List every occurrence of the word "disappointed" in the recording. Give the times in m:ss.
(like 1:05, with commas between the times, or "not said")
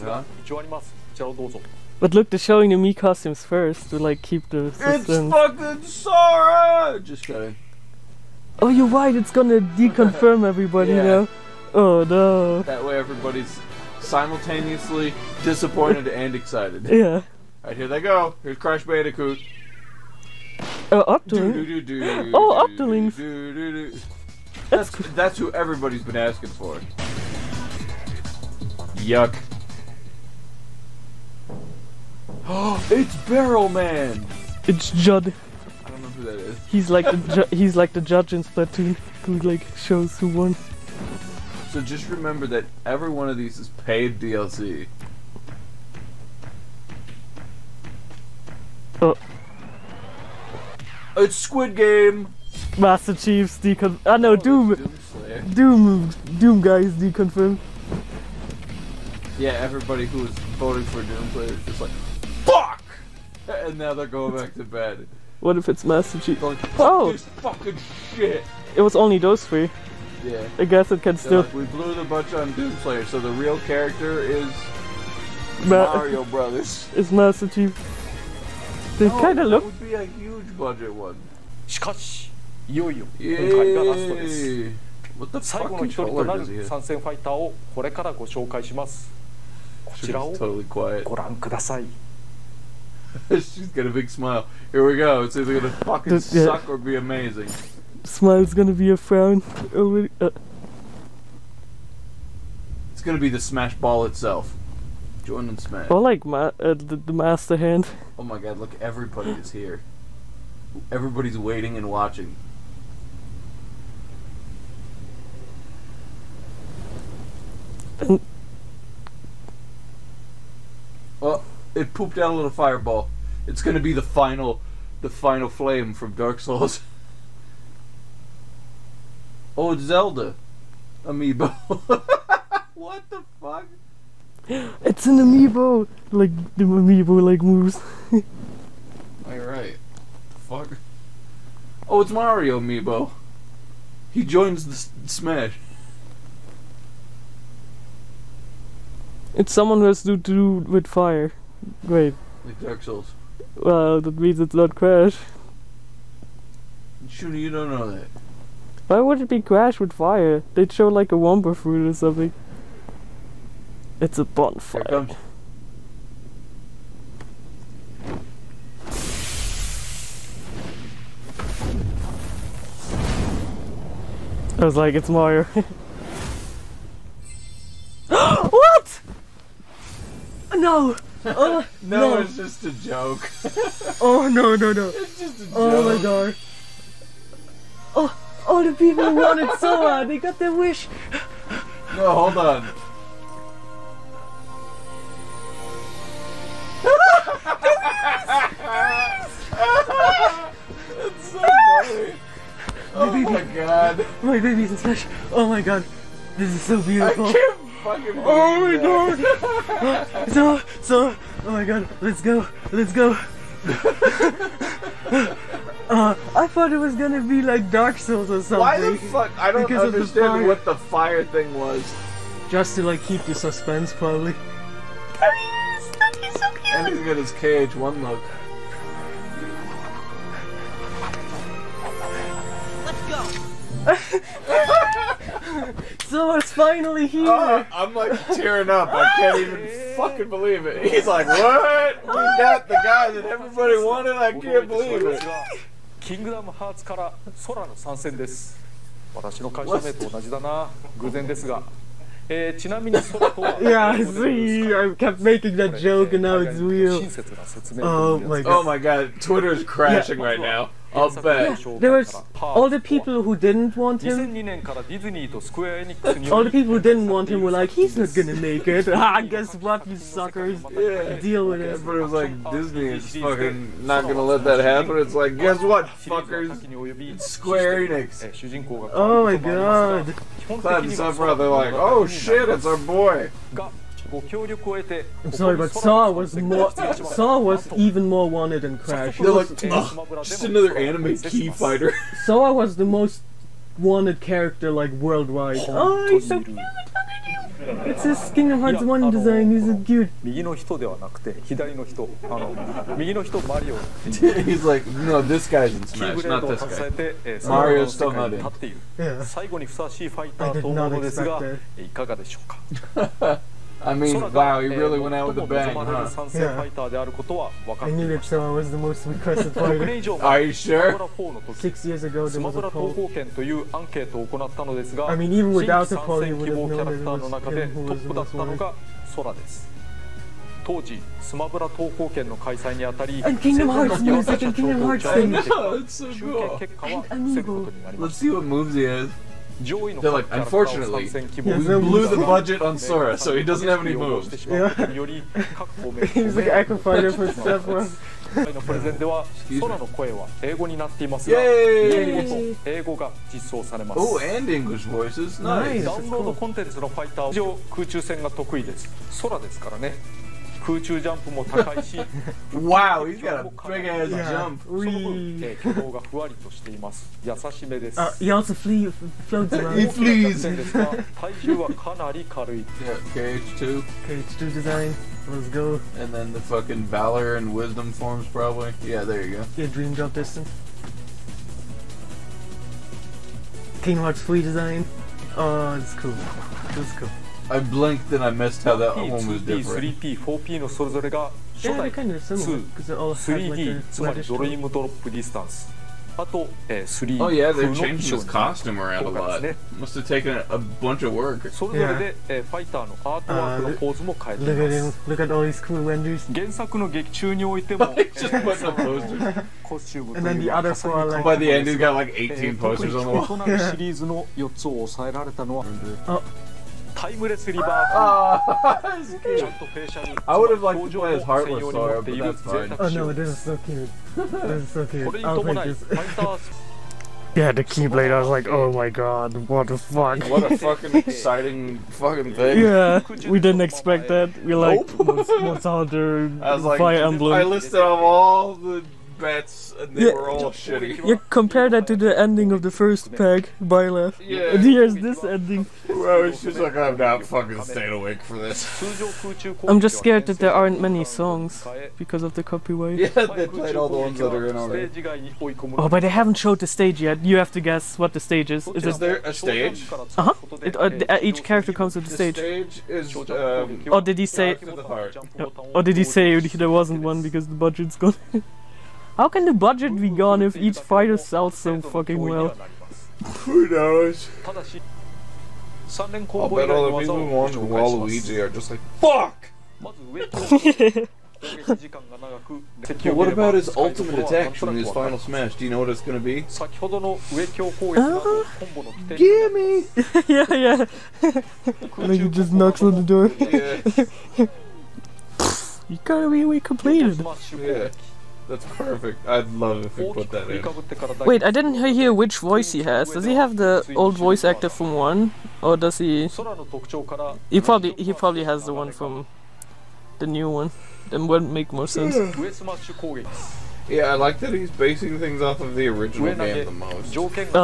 0:15.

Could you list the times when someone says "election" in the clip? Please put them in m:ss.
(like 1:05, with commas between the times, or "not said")
not said.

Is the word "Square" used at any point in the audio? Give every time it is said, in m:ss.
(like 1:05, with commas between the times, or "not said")
4:37.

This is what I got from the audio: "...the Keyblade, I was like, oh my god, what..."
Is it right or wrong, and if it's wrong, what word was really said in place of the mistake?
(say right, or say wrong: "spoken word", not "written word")
right.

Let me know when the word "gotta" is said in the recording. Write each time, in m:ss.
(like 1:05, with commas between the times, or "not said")
8:16.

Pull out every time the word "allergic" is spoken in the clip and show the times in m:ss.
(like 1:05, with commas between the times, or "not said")
not said.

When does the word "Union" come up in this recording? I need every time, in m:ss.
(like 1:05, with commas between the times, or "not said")
not said.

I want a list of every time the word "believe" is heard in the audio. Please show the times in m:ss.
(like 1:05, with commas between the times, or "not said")
4:00, 4:04.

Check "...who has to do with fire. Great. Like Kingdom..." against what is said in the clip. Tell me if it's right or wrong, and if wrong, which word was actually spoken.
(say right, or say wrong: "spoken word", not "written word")
wrong: "Dark", not "Kingdom".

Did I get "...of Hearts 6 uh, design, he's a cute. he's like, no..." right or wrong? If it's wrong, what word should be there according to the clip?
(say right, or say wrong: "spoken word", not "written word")
wrong: "1", not "6".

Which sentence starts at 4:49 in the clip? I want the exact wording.
They're like, Ugh, just another anime key fighter.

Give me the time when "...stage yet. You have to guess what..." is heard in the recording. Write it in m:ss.
7:36.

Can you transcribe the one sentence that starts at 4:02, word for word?
We oh got the guy that everybody wanted.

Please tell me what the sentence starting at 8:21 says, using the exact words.
Wait, I didn't hear which voice he has.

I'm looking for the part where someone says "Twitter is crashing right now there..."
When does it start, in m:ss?
4:19.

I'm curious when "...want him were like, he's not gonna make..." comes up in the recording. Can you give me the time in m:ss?
4:27.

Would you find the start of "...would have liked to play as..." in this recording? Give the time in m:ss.
6:57.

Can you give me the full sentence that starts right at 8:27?
He probably he probably has the one from the new one.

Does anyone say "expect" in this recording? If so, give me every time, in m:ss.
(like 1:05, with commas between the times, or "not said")
5:10, 7:13.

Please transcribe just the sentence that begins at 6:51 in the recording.
By the end, he's got like 18 posters on the wall.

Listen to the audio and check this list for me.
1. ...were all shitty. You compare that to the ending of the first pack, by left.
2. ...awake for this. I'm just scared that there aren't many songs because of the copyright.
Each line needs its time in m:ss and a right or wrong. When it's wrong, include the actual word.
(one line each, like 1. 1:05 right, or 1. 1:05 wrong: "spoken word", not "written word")
1. 7:20 right
2. 7:27 right.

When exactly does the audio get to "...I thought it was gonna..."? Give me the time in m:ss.
3:36.